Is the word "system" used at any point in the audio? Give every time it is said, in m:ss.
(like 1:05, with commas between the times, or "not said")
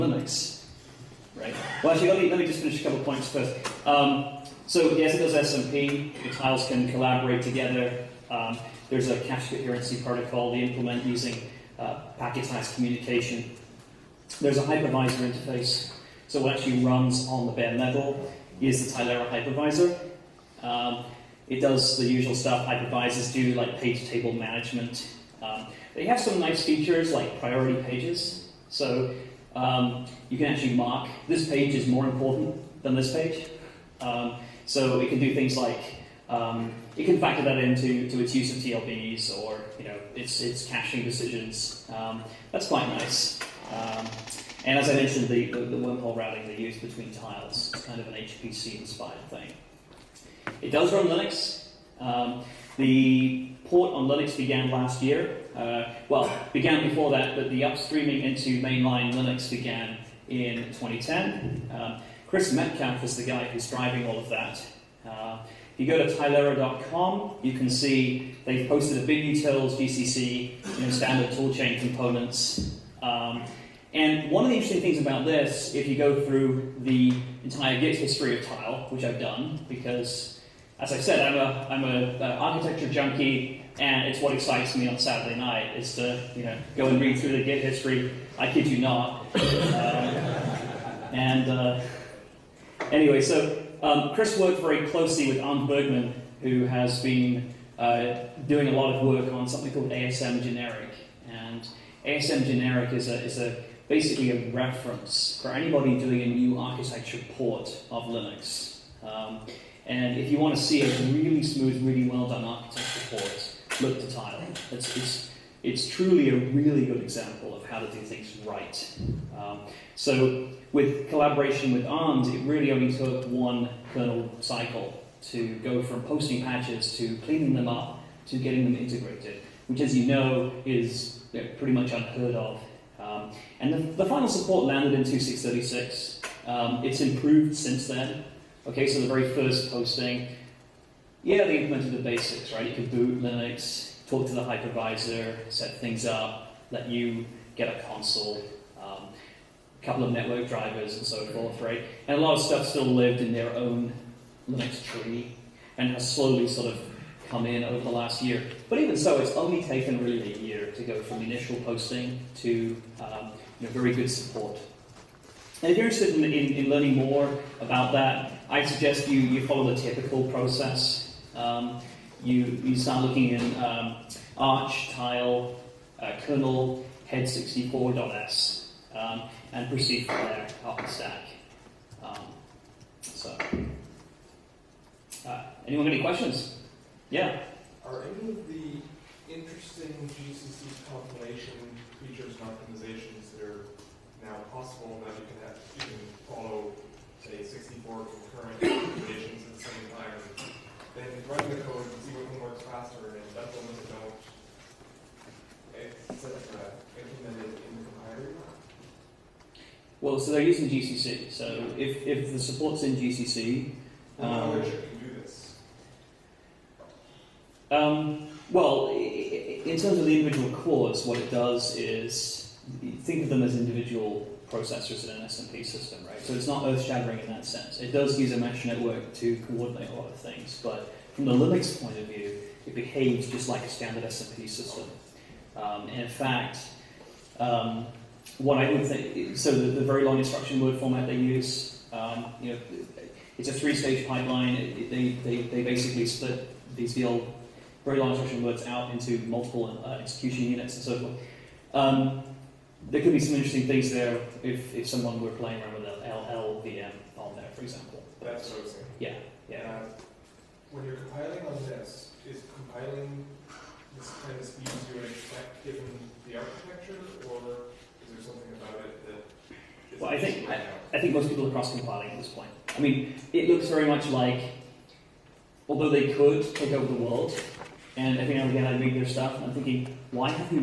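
3:45, 3:54.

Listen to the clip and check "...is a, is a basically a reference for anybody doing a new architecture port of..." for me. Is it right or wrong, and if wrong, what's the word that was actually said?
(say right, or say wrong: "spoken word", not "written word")
right.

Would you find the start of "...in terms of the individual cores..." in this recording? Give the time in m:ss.
3:38.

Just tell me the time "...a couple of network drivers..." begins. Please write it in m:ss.
2:29.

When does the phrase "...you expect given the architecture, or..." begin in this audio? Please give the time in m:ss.
4:24.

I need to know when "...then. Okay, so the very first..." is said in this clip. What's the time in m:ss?
2:17.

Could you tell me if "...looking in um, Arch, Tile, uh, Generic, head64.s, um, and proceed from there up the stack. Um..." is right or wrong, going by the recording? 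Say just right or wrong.
wrong.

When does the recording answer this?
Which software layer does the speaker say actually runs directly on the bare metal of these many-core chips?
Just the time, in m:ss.
0:19.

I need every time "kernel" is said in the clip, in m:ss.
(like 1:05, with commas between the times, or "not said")
2:03, 2:56.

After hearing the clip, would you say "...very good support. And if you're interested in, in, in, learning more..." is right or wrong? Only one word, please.
right.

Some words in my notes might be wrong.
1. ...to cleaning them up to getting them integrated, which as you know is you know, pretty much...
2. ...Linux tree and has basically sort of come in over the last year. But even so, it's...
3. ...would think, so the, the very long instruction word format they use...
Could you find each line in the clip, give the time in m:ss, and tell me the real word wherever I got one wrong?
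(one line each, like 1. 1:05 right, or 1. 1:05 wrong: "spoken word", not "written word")
1. 2:06 right
2. 2:34 wrong: "slowly", not "basically"
3. 3:58 right.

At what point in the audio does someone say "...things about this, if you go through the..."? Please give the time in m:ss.
1:14.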